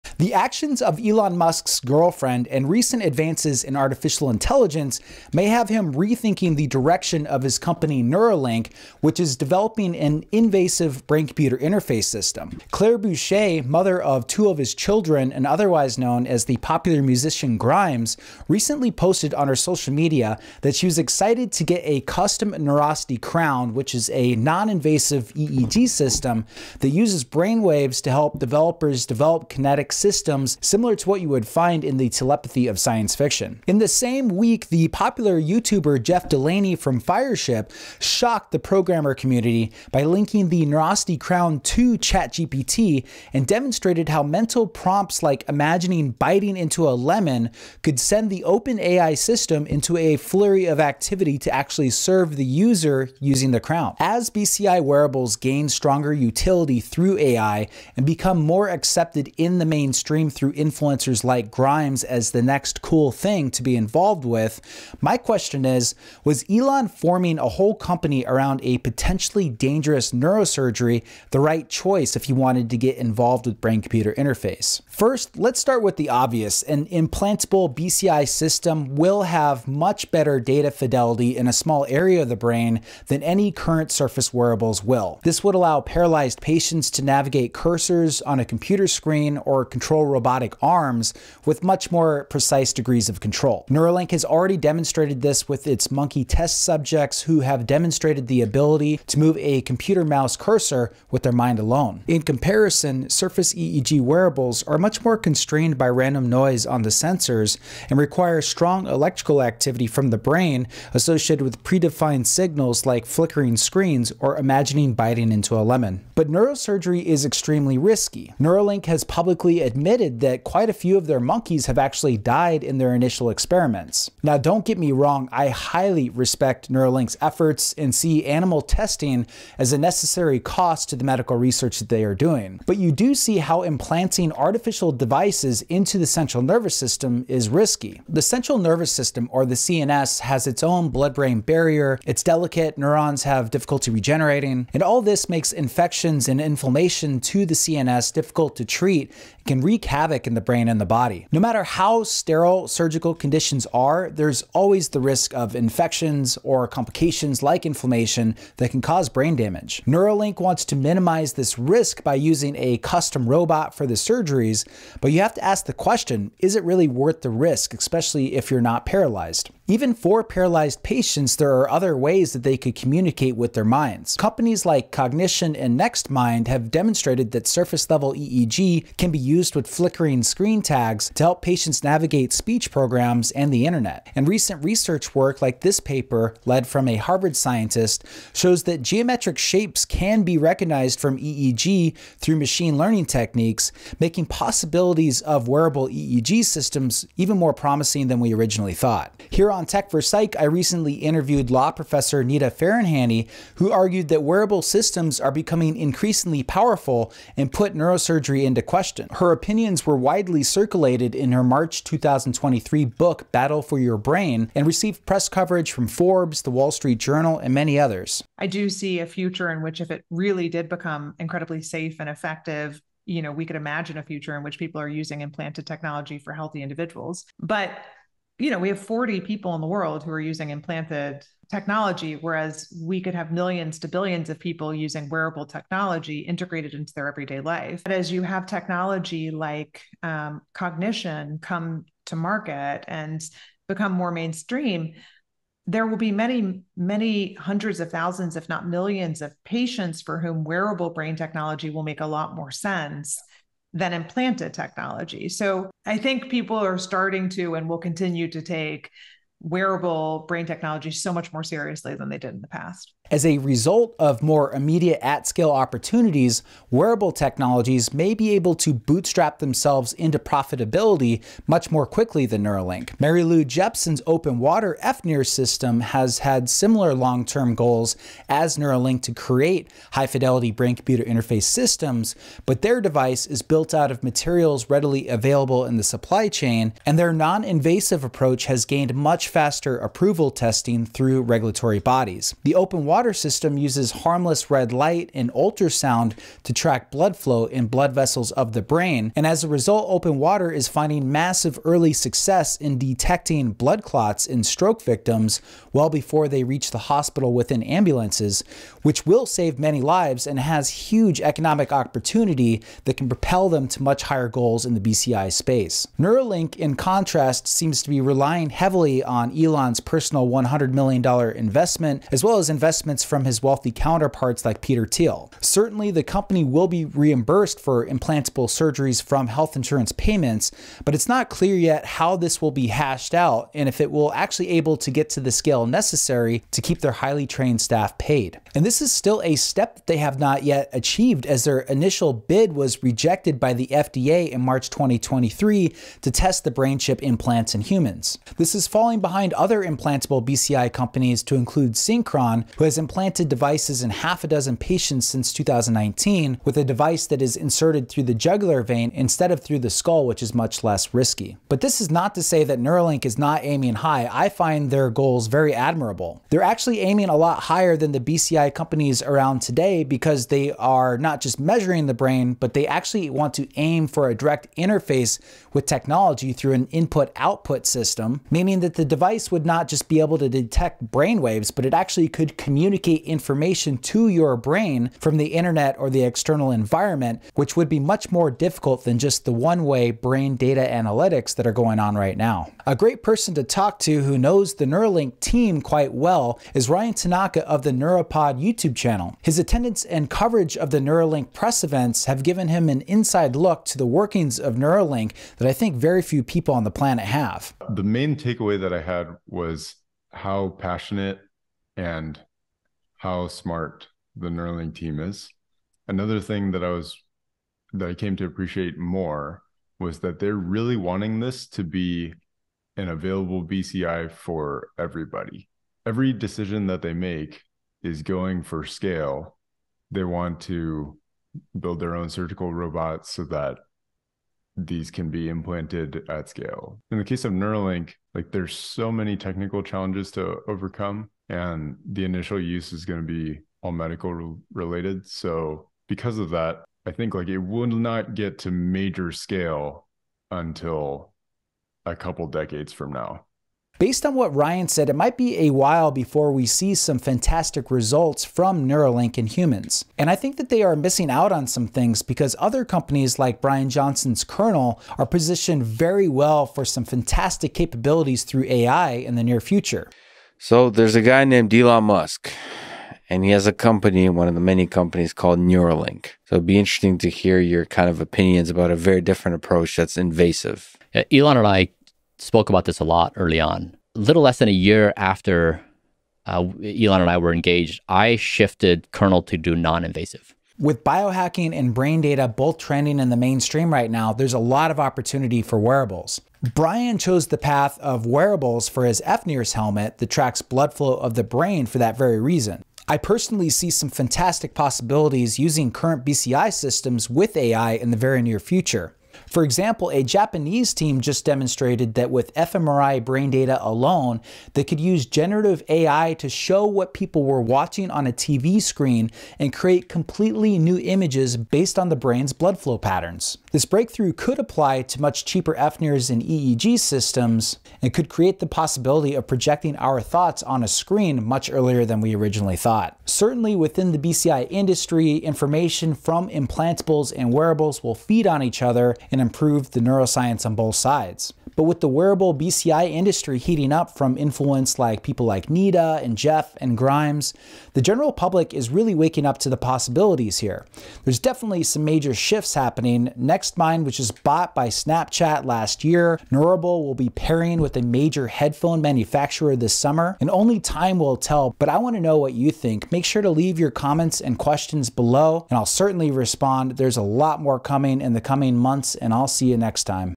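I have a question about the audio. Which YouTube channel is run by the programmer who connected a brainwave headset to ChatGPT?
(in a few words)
Fireship.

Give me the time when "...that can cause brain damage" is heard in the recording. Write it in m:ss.
2:38.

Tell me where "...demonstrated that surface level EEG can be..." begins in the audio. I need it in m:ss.
2:56.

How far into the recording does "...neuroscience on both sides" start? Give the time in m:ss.
8:59.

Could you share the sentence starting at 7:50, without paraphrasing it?
So there's a guy named Elon Musk, and he has a company, one of the many companies called Neuralink.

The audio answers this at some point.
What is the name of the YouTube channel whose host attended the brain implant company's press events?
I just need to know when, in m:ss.
6:37.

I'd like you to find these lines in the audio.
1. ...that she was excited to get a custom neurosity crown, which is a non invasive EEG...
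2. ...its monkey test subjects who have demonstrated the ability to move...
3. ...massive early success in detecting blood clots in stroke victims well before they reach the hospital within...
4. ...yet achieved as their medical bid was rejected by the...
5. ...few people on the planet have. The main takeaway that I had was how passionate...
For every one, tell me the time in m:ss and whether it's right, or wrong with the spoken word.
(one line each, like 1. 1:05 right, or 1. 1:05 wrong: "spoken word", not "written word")
1. 0:20 right
2. 1:35 right
3. 5:01 right
4. 5:40 wrong: "initial", not "medical"
5. 6:46 right.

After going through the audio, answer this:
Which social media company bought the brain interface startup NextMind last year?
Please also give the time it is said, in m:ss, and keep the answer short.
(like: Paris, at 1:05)
Snapchat, at 9:14.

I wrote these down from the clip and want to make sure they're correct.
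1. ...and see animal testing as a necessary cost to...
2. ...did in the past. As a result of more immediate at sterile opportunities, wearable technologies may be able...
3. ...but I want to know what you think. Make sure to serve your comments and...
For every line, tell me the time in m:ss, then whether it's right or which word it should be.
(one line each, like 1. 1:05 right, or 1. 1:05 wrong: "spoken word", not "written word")
1. 2:07 right
2. 4:22 wrong: "scale", not "sterile"
3. 9:21 wrong: "leave", not "serve".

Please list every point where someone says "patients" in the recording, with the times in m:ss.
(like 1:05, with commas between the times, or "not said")
1:26, 2:50, 3:01, 4:09, 5:54.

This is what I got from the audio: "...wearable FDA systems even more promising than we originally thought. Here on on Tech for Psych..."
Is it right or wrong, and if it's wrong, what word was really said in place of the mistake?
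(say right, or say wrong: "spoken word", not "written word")
wrong: "EEG", not "FDA".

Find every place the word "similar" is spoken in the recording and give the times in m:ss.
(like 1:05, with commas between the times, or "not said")
0:30, 4:36.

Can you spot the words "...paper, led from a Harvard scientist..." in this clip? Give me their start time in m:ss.
3:05.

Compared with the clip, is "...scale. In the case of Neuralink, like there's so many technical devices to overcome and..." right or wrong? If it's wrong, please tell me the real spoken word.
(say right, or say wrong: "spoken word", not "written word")
wrong: "challenges", not "devices".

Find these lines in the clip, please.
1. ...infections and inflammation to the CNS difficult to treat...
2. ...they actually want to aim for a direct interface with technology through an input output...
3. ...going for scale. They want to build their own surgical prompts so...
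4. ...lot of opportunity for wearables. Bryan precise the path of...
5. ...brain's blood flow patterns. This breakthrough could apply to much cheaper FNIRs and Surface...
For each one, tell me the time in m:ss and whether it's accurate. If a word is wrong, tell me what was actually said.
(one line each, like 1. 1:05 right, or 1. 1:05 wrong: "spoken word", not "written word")
1. 2:26 right
2. 6:12 right
3. 7:08 wrong: "robots", not "prompts"
4. 8:14 wrong: "chose", not "precise"
5. 8:41 wrong: "EEG", not "Surface".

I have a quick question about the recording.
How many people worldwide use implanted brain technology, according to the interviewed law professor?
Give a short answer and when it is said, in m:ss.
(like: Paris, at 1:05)
40, at 3:48.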